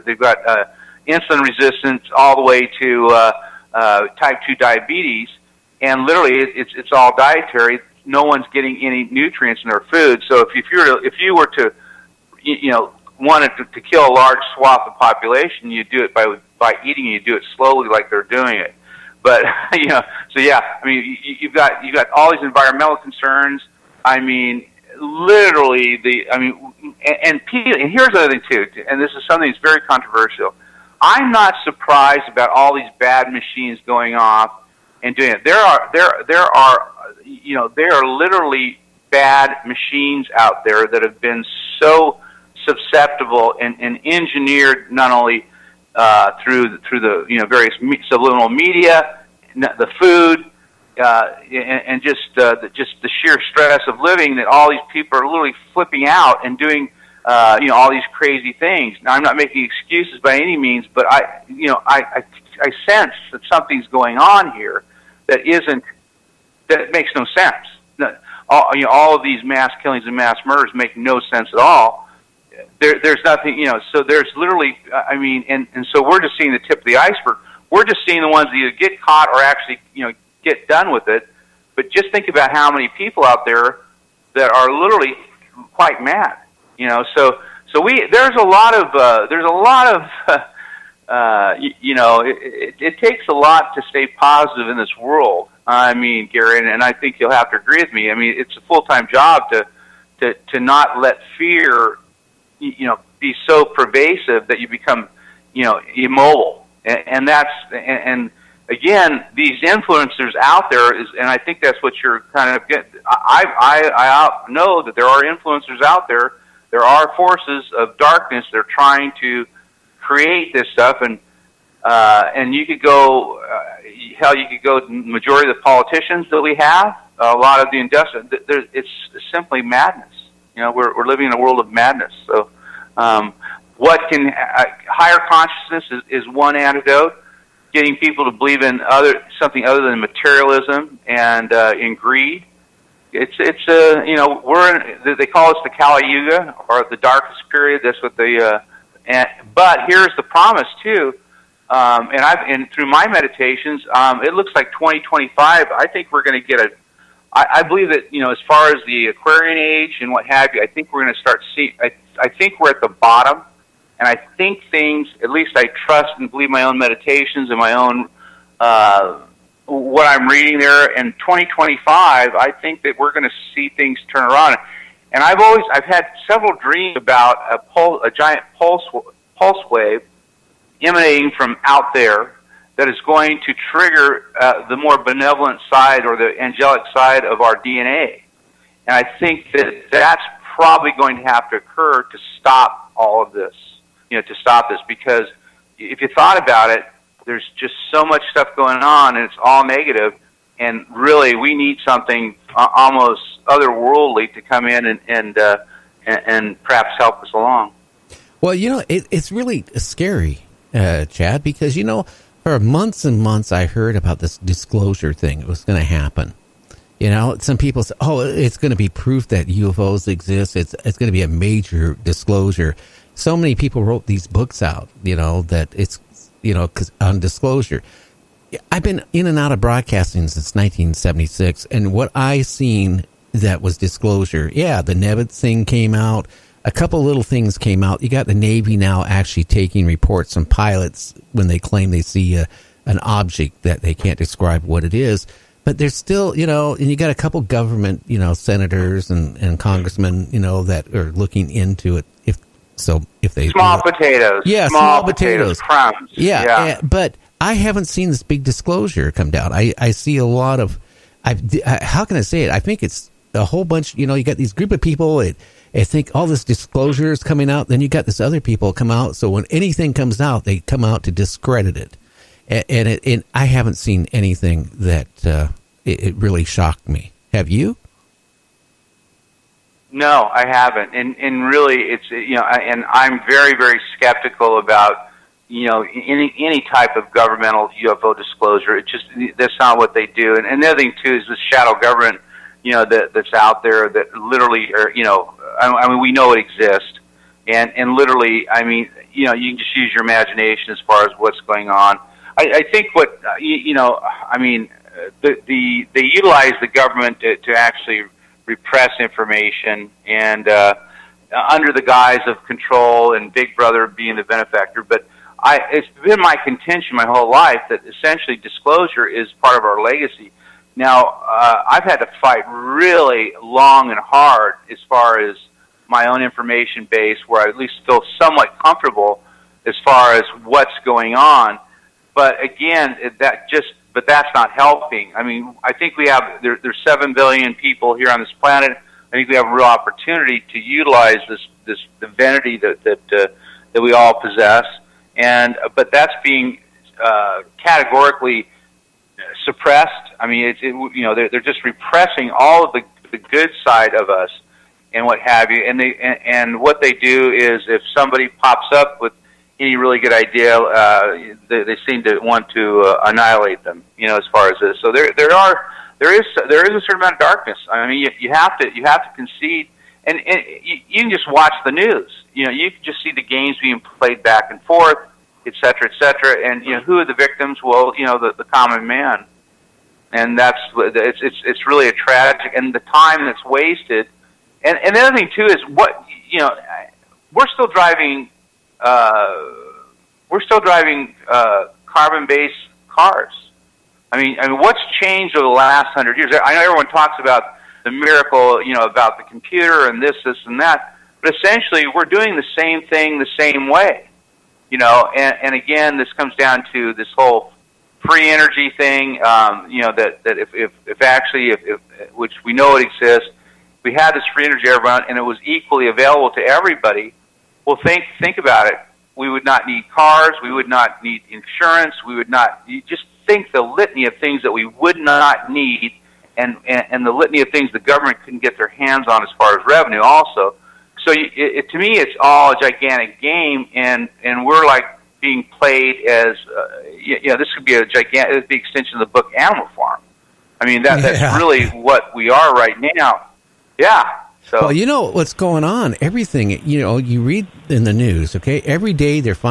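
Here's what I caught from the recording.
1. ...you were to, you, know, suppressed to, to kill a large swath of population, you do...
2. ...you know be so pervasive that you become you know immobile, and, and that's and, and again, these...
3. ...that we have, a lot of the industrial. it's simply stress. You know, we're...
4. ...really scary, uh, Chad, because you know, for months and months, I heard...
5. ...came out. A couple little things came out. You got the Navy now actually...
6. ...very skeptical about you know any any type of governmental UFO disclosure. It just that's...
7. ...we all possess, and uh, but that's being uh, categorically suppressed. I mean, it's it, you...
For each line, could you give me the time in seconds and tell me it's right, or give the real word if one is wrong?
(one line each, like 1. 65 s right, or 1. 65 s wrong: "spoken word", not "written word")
1. 11 s wrong: "wanted", not "suppressed"
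2. 102 s right
3. 126 s wrong: "madness", not "stress"
4. 209 s right
5. 235 s right
6. 283 s right
7. 343 s right.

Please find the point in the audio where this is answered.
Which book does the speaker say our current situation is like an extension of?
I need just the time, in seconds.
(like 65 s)
439 s.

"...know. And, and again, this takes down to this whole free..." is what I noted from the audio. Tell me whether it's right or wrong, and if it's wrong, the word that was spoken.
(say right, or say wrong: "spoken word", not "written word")
wrong: "comes", not "takes".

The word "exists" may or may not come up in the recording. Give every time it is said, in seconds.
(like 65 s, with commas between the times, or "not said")
220 s, 296 s, 412 s.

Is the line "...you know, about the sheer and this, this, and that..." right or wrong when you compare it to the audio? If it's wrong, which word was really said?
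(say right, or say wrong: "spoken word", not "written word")
wrong: "computer", not "sheer".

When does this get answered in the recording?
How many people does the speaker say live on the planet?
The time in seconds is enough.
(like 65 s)
336 s.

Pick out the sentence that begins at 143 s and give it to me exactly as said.
It's it's uh, you know we're in, they call us the Kali Yuga or the darkest period.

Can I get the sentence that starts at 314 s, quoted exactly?
But I, it's been my contention my whole life that essentially disclosure is part of our legacy.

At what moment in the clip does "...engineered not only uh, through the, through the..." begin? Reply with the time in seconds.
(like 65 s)
44 s.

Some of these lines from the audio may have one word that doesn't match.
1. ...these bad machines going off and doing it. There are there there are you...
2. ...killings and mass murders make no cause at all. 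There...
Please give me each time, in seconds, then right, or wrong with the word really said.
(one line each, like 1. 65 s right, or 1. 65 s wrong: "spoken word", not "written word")
1. 32 s right
2. 69 s wrong: "sense", not "cause".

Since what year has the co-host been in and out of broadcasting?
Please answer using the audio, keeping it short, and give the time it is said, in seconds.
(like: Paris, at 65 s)
1976, at 230 s.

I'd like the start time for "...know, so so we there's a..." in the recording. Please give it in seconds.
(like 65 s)
86 s.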